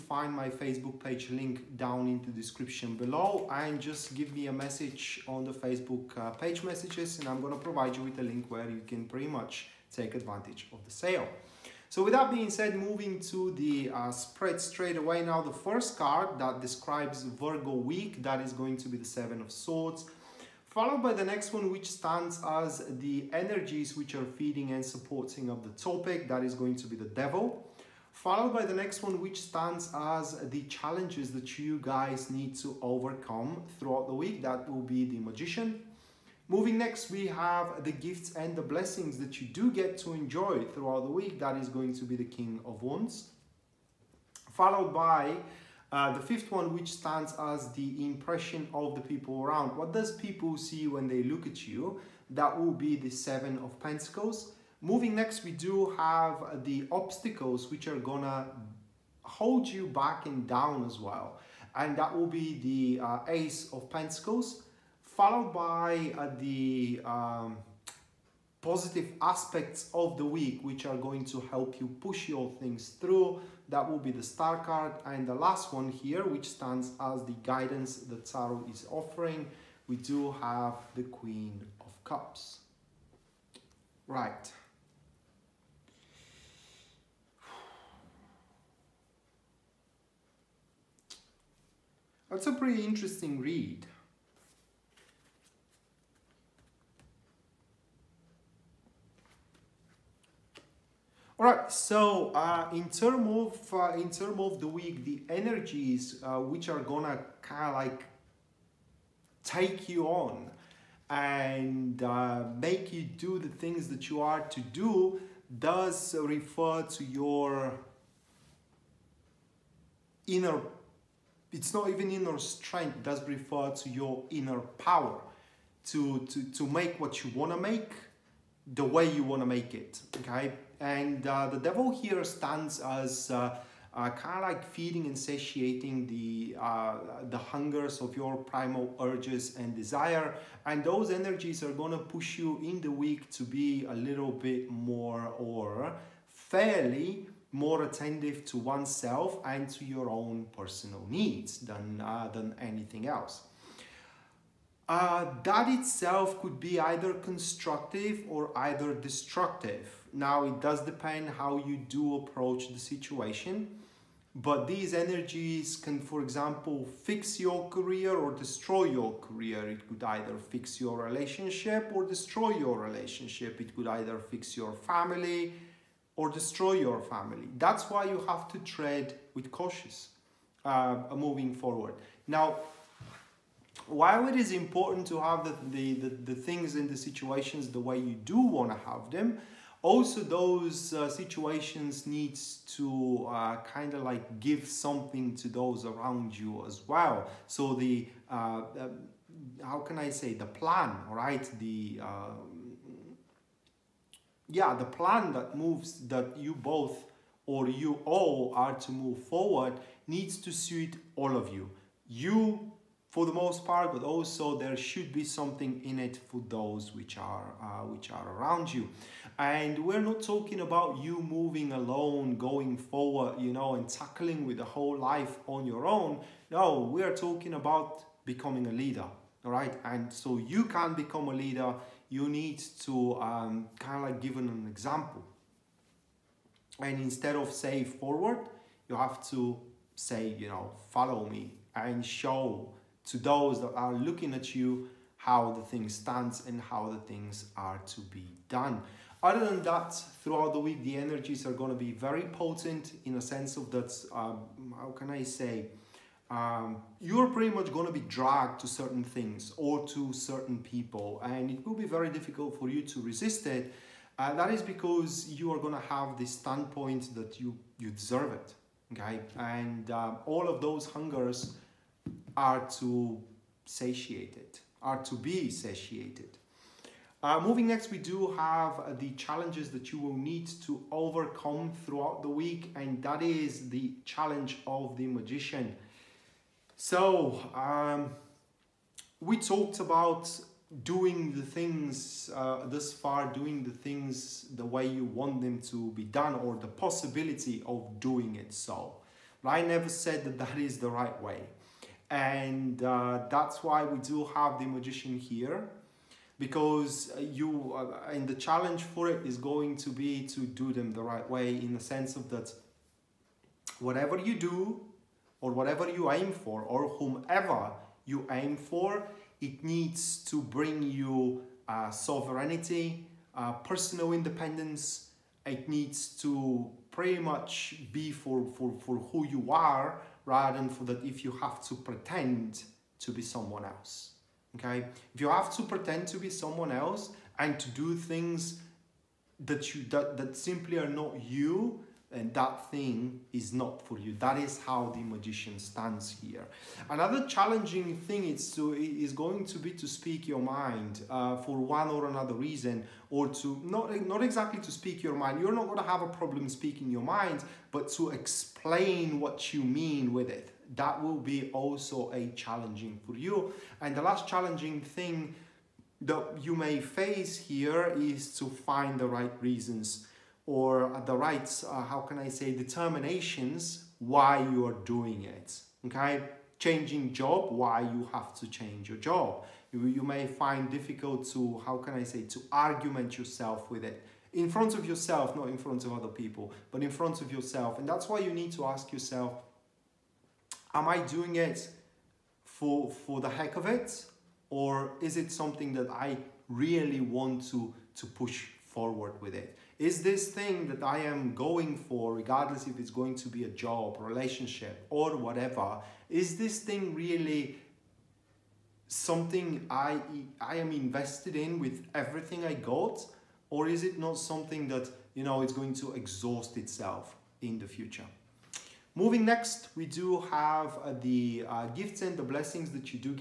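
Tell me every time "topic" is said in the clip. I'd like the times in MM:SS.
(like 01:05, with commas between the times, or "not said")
00:25.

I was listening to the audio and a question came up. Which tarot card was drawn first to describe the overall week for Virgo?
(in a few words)
Seven of Swords.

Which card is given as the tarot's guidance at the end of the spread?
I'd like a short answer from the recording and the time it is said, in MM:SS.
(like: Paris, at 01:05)
Queen of Cups, at 01:21.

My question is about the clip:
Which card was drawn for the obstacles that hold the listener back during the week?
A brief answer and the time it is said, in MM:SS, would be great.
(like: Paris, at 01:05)
Ace of Pentacles, at 01:03.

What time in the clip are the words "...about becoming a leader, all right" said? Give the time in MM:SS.
03:47.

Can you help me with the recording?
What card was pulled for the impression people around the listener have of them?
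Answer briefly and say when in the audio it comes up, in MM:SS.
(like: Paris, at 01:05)
Seven of Pentacles, at 00:53.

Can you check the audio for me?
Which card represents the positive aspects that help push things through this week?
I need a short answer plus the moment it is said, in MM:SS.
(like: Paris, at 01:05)
The Star, at 01:14.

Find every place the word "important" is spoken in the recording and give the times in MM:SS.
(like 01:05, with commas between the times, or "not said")
03:04.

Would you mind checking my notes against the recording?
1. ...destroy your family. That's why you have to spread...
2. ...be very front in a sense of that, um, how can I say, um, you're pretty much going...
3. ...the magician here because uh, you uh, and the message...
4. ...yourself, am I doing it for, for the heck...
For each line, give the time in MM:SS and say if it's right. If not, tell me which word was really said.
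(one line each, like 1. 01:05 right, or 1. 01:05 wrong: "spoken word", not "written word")
1. 02:56 wrong: "tread", not "spread"
2. 04:11 wrong: "potent", not "front"
3. 05:04 wrong: "challenge", not "message"
4. 06:28 right.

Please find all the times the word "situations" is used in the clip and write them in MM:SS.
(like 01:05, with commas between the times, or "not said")
02:42, 03:06, 03:11.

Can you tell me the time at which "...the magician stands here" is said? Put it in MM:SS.
05:44.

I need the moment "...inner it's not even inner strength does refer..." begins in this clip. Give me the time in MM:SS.
02:00.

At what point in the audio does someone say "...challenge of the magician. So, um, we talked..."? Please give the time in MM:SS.
04:44.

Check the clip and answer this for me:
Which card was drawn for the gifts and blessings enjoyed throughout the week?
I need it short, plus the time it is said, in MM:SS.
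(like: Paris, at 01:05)
King of Wands, at 00:42.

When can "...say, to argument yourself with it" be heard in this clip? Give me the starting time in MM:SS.
06:22.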